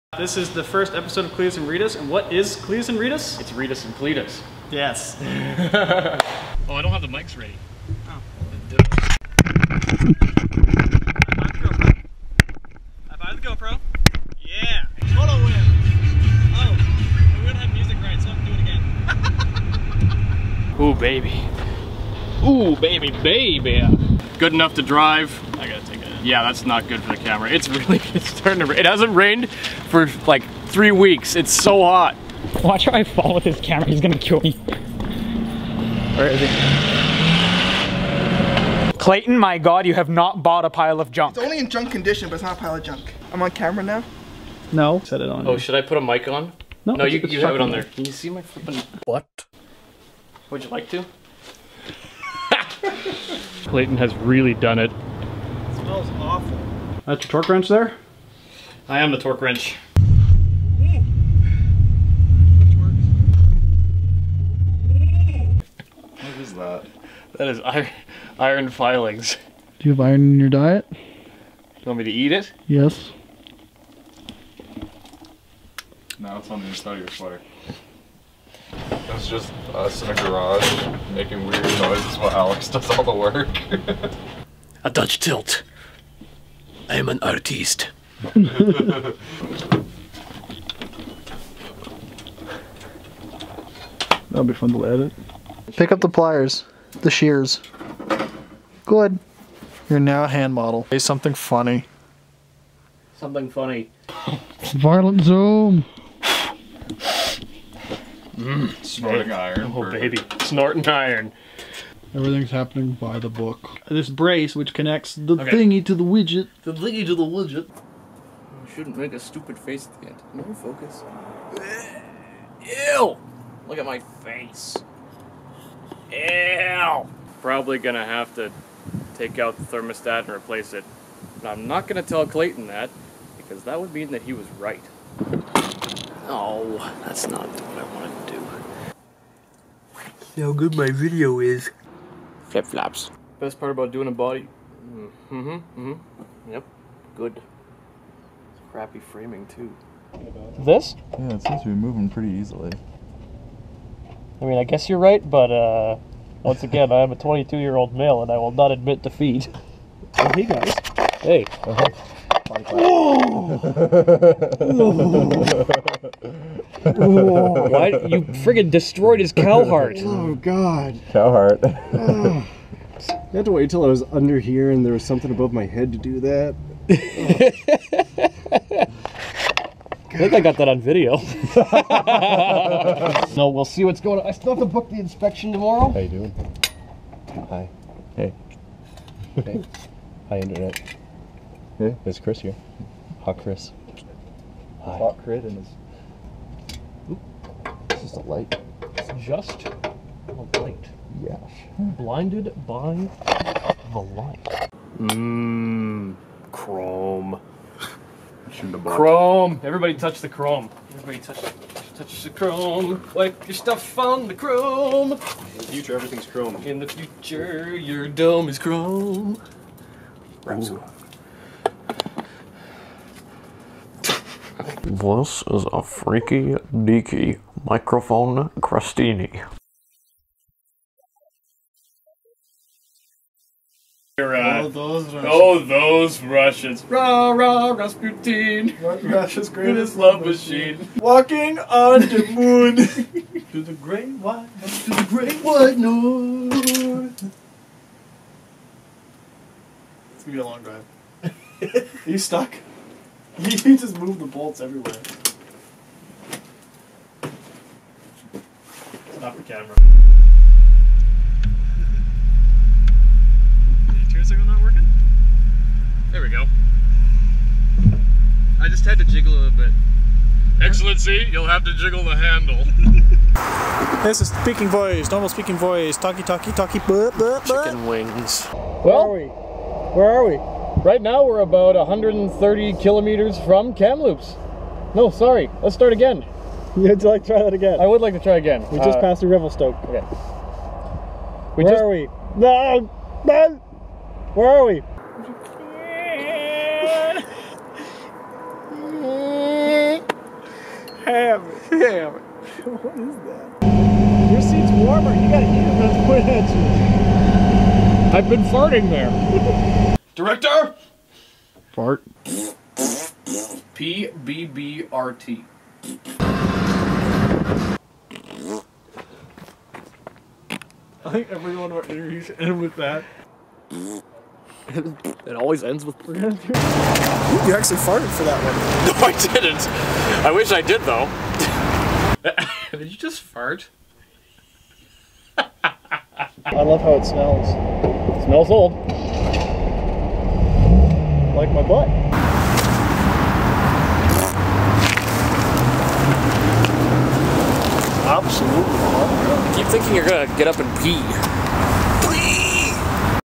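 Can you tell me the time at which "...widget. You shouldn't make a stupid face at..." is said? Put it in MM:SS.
01:57.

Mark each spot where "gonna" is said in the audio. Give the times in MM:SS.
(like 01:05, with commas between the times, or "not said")
00:34, 02:07, 02:11, 05:50.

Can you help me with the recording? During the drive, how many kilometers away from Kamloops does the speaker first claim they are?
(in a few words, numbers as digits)
130.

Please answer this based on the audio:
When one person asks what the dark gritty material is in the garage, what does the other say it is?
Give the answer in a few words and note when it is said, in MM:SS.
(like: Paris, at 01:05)
Iron filings, at 01:08.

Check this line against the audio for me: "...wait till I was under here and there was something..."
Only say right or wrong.
right.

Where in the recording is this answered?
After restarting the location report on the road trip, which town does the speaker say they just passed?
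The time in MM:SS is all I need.
04:49.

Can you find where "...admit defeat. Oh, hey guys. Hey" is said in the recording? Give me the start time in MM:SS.
02:38.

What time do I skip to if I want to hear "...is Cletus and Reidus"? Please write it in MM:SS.
00:02.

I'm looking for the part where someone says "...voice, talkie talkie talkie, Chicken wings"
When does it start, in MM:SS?
04:35.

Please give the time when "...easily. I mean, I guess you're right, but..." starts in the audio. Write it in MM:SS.
02:32.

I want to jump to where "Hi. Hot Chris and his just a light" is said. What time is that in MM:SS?
03:14.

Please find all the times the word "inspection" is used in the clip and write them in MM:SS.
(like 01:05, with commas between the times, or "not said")
03:04.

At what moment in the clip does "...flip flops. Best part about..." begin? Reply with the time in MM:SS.
02:22.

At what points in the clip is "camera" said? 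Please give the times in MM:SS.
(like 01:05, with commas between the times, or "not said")
00:27, 00:33, 00:43, 04:19.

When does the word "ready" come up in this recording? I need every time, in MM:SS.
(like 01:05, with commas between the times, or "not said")
00:07.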